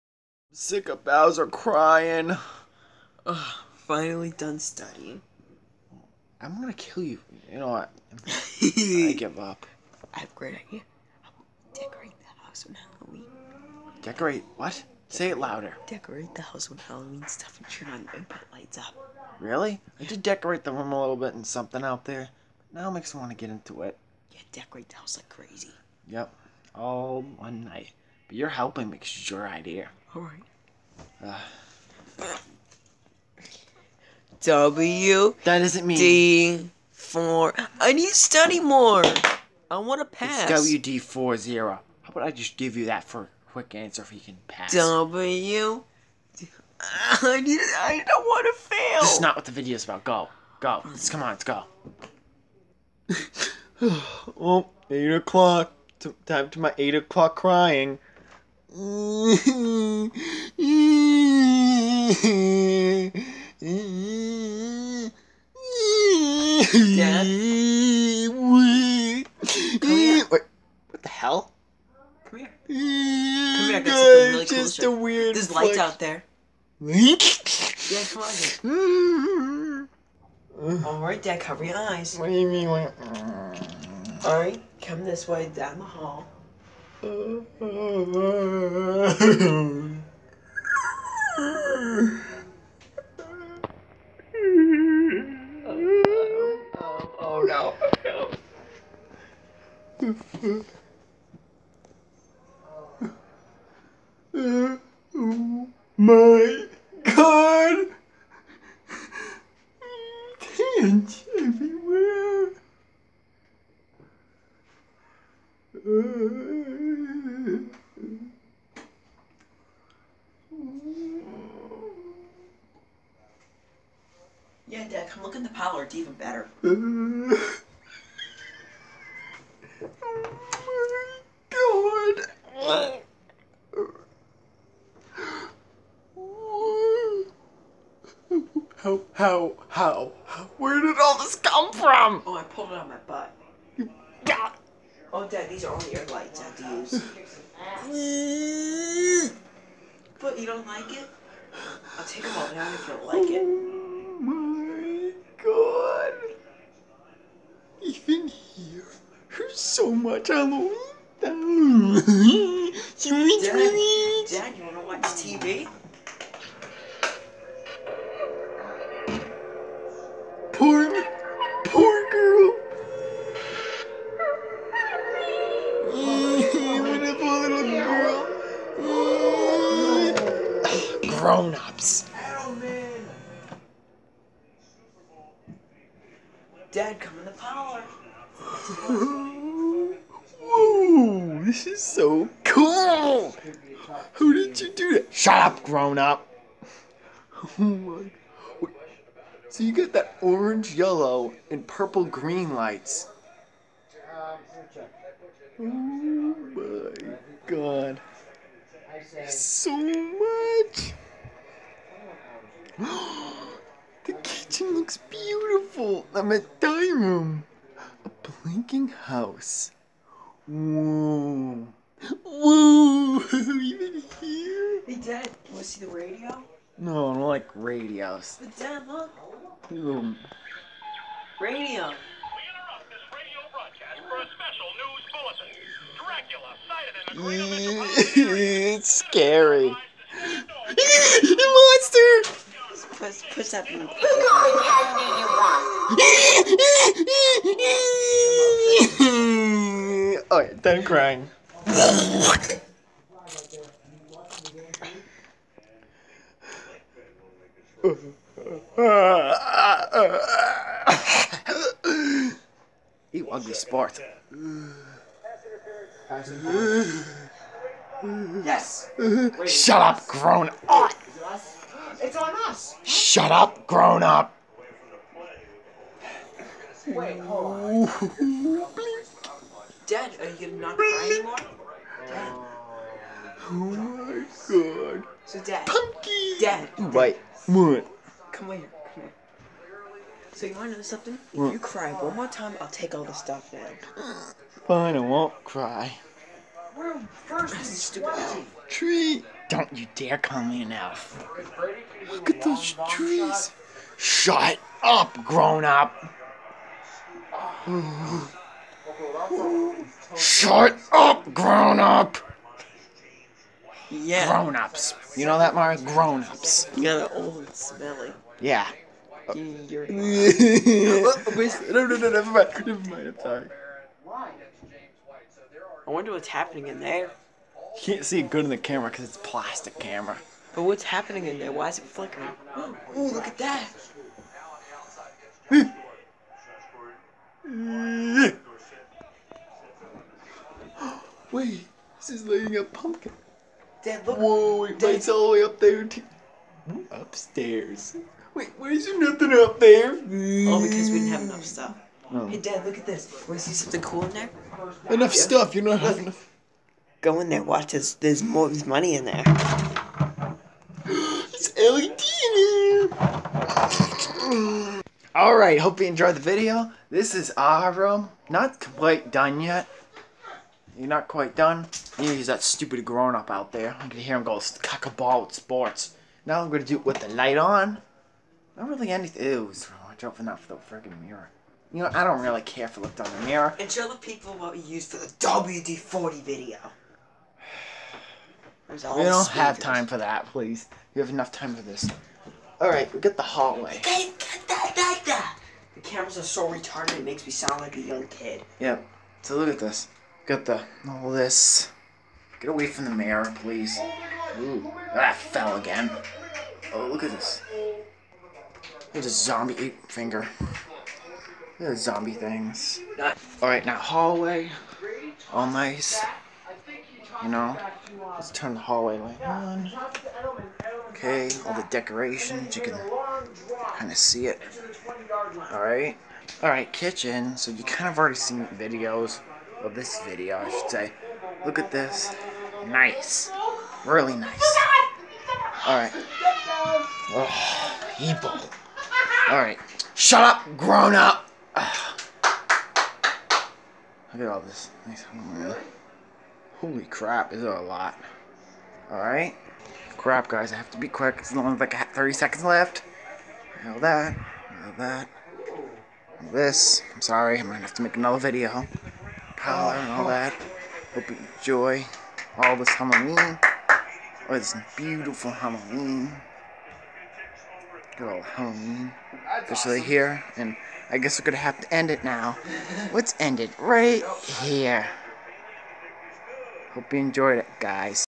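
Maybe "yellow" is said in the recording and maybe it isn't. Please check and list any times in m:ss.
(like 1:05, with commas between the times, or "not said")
3:20.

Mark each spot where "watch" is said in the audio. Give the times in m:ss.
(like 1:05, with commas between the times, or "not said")
2:44, 5:57, 6:19.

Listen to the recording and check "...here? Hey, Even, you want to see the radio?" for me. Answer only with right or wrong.
wrong.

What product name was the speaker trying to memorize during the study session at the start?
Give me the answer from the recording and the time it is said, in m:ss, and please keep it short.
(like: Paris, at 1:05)
WD-40, at 0:40.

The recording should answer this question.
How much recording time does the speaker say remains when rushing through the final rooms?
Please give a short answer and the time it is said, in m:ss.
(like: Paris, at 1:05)
30 seconds, at 7:31.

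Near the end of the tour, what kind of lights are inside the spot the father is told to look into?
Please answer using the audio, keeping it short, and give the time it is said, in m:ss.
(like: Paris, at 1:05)
LED, at 6:01.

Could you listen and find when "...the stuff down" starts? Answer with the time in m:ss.
4:53.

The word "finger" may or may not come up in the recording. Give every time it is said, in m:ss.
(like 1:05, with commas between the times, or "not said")
6:49.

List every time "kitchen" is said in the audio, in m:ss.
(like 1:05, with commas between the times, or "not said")
3:34, 7:06.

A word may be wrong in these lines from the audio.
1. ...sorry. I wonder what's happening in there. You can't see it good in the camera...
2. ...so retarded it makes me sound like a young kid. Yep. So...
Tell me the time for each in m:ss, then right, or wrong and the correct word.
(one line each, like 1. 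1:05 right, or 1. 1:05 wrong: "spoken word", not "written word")
1. 5:23 right
2. 6:36 right.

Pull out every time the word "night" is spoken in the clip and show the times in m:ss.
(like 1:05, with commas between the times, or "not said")
0:27.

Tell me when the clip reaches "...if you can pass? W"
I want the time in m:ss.
0:44.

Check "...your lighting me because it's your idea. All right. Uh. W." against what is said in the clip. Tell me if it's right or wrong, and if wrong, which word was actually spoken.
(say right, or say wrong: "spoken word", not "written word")
wrong: "helping", not "lighting".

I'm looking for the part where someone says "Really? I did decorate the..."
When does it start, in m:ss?
0:19.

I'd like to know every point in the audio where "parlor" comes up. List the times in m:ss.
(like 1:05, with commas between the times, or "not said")
2:05, 3:07.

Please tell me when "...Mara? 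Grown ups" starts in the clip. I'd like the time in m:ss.
5:15.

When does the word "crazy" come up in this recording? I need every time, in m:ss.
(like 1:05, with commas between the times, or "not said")
0:25.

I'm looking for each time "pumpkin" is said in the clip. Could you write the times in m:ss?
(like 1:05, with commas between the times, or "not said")
4:45, 5:42.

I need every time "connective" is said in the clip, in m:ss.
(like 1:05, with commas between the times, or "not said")
not said.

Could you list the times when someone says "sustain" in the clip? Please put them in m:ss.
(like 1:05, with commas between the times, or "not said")
not said.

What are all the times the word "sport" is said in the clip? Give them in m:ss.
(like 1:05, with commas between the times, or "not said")
4:23, 6:15.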